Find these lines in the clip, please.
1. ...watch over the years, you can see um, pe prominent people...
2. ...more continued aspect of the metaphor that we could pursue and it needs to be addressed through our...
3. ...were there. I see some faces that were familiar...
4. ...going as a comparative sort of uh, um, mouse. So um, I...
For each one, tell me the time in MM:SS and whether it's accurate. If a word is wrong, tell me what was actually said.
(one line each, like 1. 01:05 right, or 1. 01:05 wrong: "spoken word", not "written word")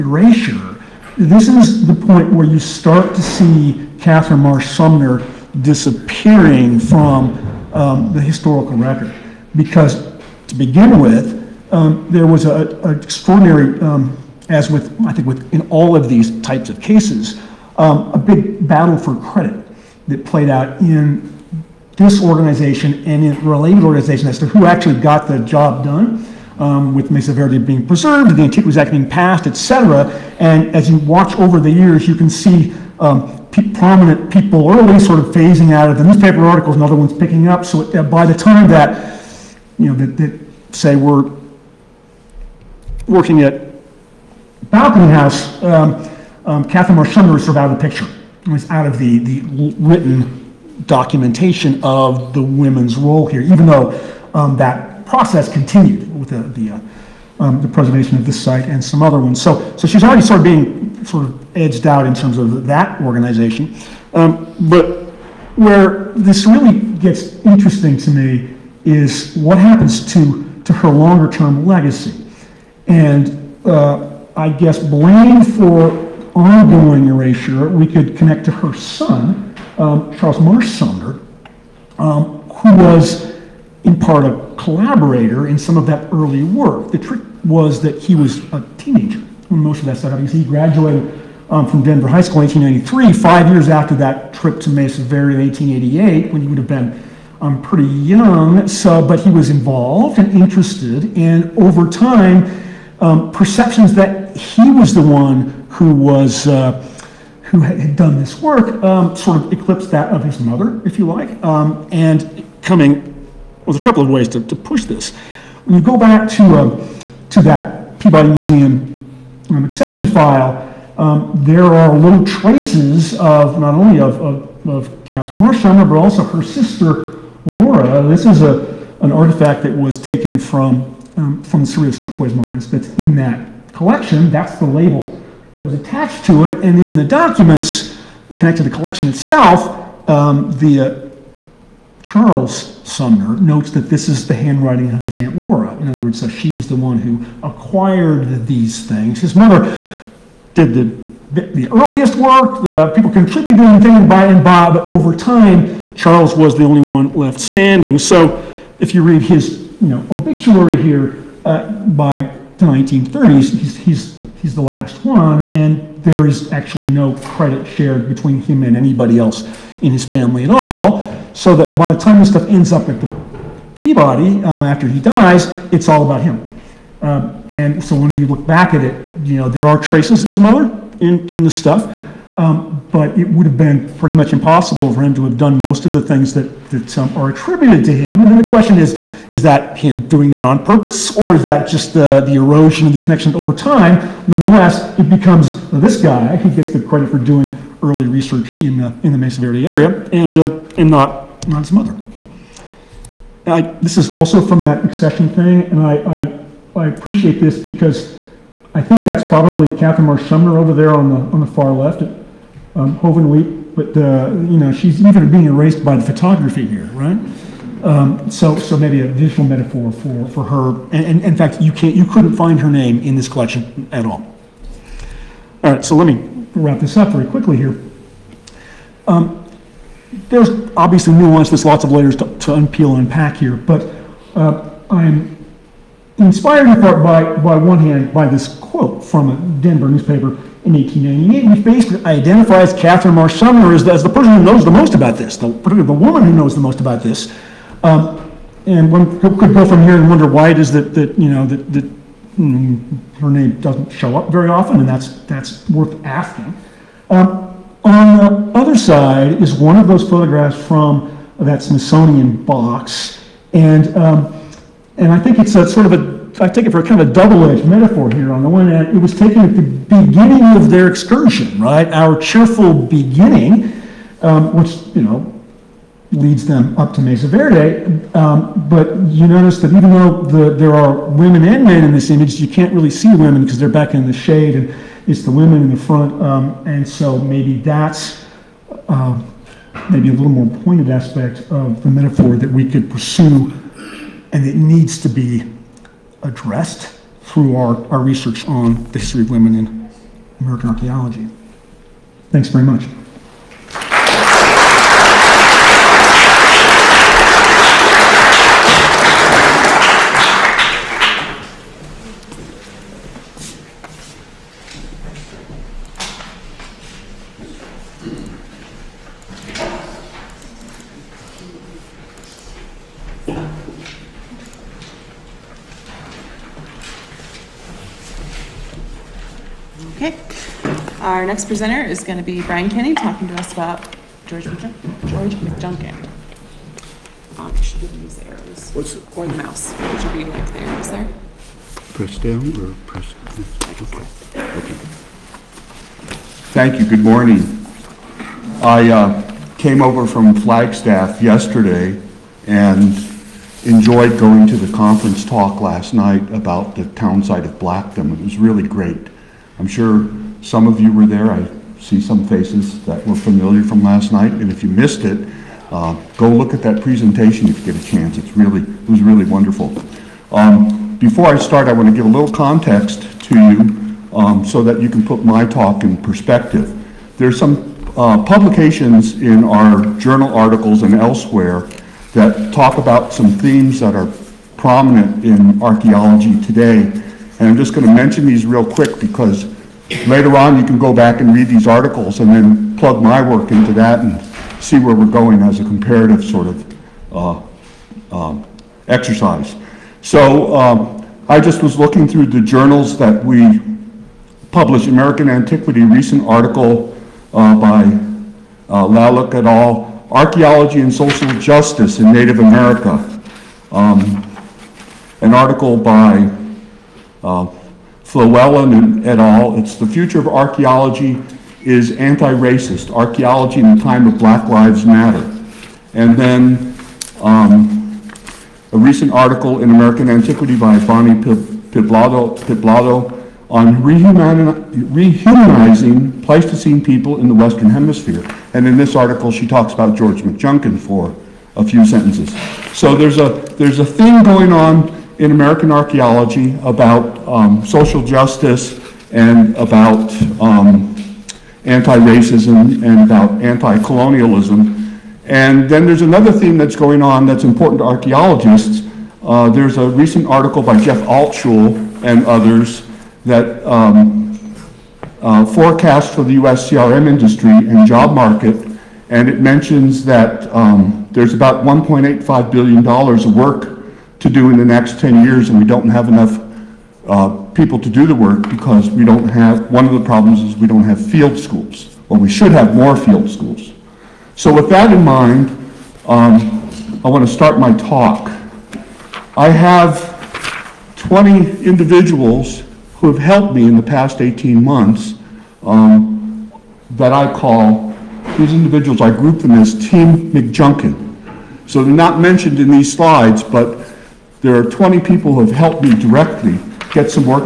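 1. 00:30 right
2. 04:50 wrong: "pointed", not "continued"
3. 06:00 right
4. 06:35 wrong: "exercise", not "mouse".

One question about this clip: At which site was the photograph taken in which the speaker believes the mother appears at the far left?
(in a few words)
Hovenweep.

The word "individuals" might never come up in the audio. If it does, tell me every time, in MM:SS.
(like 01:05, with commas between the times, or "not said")
08:11, 08:18.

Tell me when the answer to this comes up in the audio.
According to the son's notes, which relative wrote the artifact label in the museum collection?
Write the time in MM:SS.
02:25.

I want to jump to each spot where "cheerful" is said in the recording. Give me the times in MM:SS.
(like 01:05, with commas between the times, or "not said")
04:32.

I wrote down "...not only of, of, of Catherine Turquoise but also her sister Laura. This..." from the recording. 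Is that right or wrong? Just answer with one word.
wrong.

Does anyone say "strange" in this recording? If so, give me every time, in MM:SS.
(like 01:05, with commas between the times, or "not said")
not said.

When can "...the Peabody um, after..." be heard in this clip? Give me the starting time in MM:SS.
02:52.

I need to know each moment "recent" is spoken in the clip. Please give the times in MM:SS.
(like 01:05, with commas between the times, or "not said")
06:45, 07:08, 07:39.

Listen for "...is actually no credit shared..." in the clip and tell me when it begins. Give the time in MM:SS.
02:46.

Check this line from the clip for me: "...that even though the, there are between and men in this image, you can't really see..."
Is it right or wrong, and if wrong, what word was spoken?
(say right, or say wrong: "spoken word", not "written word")
wrong: "women", not "between".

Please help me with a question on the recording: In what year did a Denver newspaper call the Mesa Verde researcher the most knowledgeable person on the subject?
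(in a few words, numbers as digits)
1898.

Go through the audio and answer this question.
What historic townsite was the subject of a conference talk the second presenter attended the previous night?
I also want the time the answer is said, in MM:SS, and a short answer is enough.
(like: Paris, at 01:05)
Blackdom, at 05:57.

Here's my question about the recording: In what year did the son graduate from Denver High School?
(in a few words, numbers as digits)
1893.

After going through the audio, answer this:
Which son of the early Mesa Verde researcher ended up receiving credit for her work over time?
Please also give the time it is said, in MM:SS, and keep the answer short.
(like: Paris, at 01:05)
Charles Marsh Sumner, at 01:20.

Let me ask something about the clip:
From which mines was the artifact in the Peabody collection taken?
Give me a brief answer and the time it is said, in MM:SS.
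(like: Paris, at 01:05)
Cerrillos Turquoise Mines, at 02:11.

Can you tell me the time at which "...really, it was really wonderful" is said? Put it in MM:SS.
06:08.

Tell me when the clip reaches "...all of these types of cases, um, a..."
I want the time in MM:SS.
00:15.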